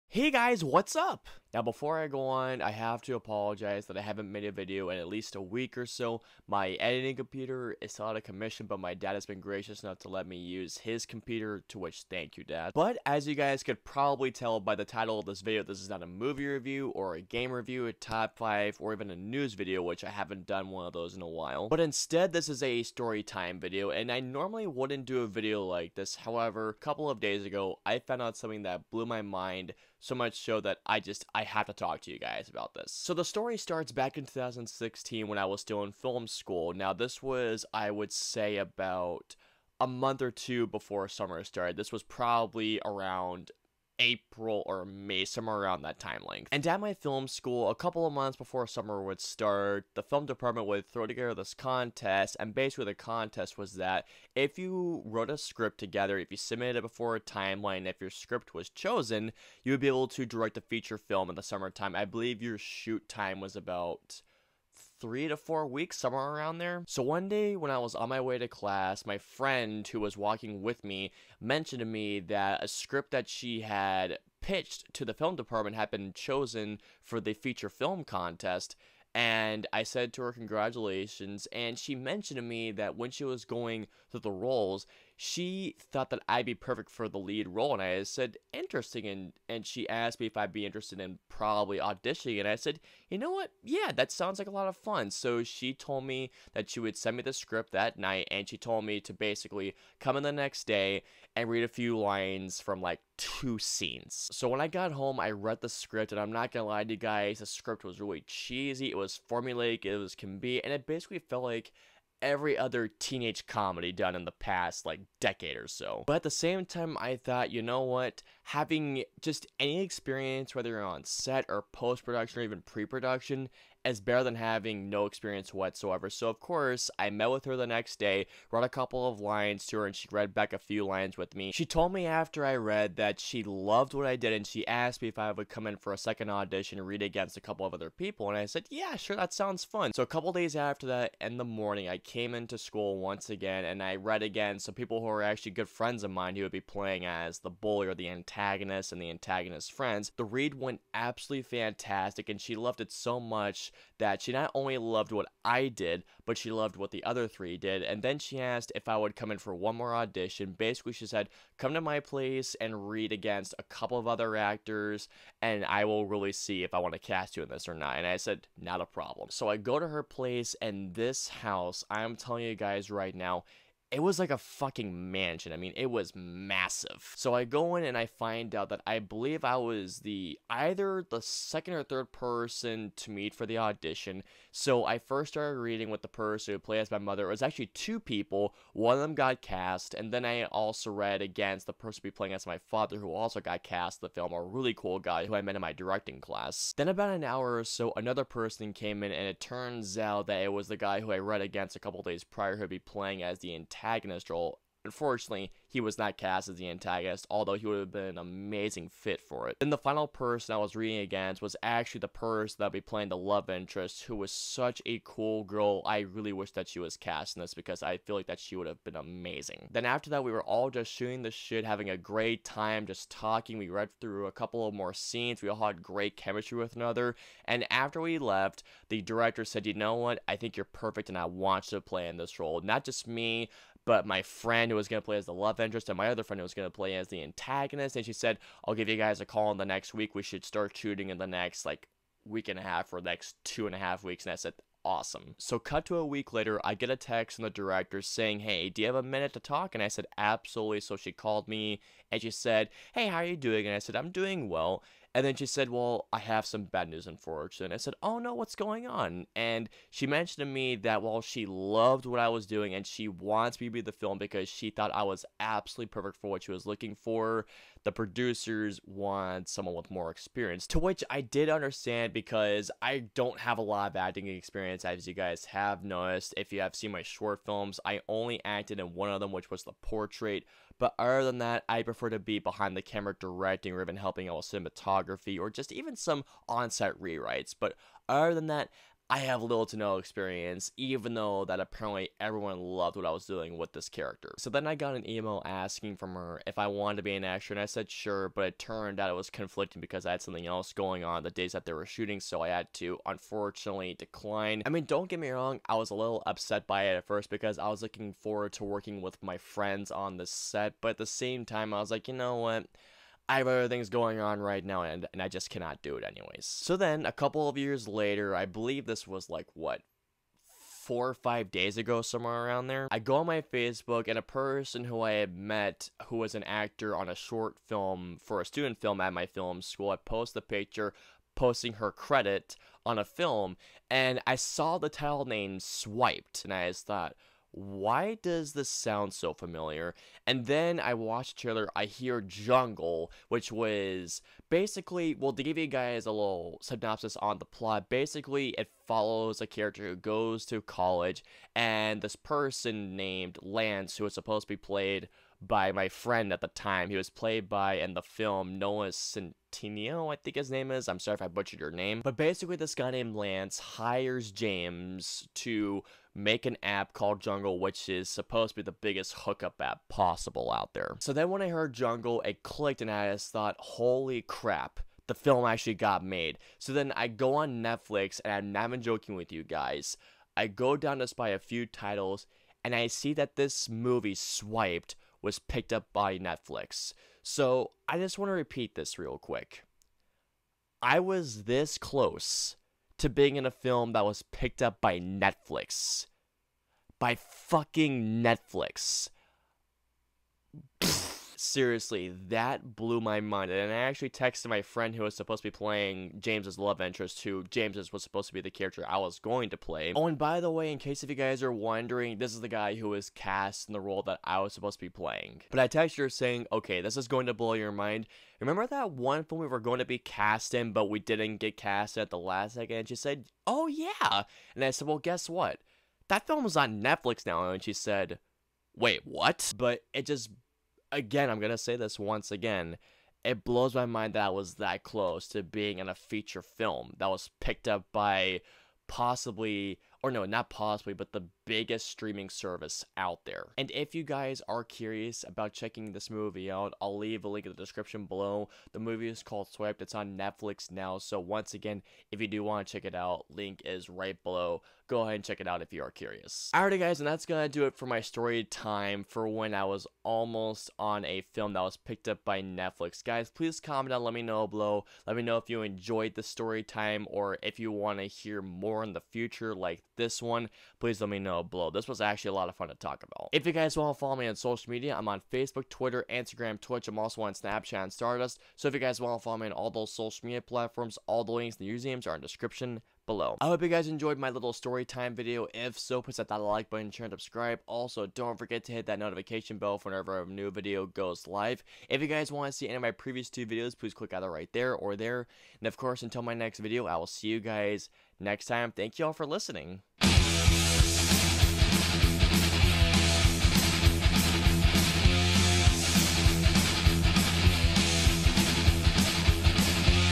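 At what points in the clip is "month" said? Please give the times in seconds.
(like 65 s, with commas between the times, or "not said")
39 s, 48 s.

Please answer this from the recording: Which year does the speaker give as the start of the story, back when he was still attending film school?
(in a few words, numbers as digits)
2016.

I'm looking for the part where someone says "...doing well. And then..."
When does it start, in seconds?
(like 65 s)
254 s.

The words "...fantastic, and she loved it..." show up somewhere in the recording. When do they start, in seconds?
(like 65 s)
151 s.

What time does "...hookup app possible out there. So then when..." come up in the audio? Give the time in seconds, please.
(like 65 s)
369 s.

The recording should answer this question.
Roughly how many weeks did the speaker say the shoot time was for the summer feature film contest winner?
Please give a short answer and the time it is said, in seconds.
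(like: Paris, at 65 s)
3 to 4 weeks, at 65 s.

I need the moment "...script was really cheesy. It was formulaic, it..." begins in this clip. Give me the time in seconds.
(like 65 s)
107 s.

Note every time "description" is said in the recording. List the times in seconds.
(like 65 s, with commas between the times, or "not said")
447 s, 482 s.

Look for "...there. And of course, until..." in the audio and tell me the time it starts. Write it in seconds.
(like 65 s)
494 s.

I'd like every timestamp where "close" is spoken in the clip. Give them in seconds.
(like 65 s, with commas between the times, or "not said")
391 s, 434 s.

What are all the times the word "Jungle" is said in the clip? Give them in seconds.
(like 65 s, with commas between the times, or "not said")
342 s, 367 s, 371 s.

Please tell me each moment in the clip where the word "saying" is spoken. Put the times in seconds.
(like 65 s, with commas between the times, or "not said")
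248 s, 416 s.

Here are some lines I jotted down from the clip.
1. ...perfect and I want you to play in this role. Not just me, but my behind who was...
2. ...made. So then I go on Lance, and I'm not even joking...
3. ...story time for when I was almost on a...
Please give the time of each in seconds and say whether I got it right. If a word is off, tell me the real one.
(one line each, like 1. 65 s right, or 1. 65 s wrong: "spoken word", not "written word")
1. 230 s wrong: "friend", not "behind"
2. 376 s wrong: "Netflix", not "Lance"
3. 458 s right.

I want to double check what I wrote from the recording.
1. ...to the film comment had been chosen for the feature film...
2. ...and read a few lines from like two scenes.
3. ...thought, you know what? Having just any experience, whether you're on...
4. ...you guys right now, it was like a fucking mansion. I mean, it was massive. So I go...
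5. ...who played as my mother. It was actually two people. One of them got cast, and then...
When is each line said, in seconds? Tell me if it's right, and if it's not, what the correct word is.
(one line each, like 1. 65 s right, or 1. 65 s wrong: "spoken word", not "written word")
1. 74 s wrong: "department", not "comment"
2. 101 s right
3. 117 s right
4. 172 s right
5. 186 s right.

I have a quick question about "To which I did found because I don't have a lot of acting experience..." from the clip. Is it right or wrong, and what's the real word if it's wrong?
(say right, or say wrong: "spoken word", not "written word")
wrong: "understand", not "found".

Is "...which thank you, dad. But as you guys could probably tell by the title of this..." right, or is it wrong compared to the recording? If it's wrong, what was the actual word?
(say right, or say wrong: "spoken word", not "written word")
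right.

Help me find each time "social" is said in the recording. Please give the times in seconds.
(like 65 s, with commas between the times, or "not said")
474 s, 479 s.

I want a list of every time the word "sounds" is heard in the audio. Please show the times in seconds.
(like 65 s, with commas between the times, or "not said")
94 s, 139 s, 338 s.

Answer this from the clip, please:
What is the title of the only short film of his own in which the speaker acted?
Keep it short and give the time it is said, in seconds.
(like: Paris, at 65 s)
The Portrait, at 279 s.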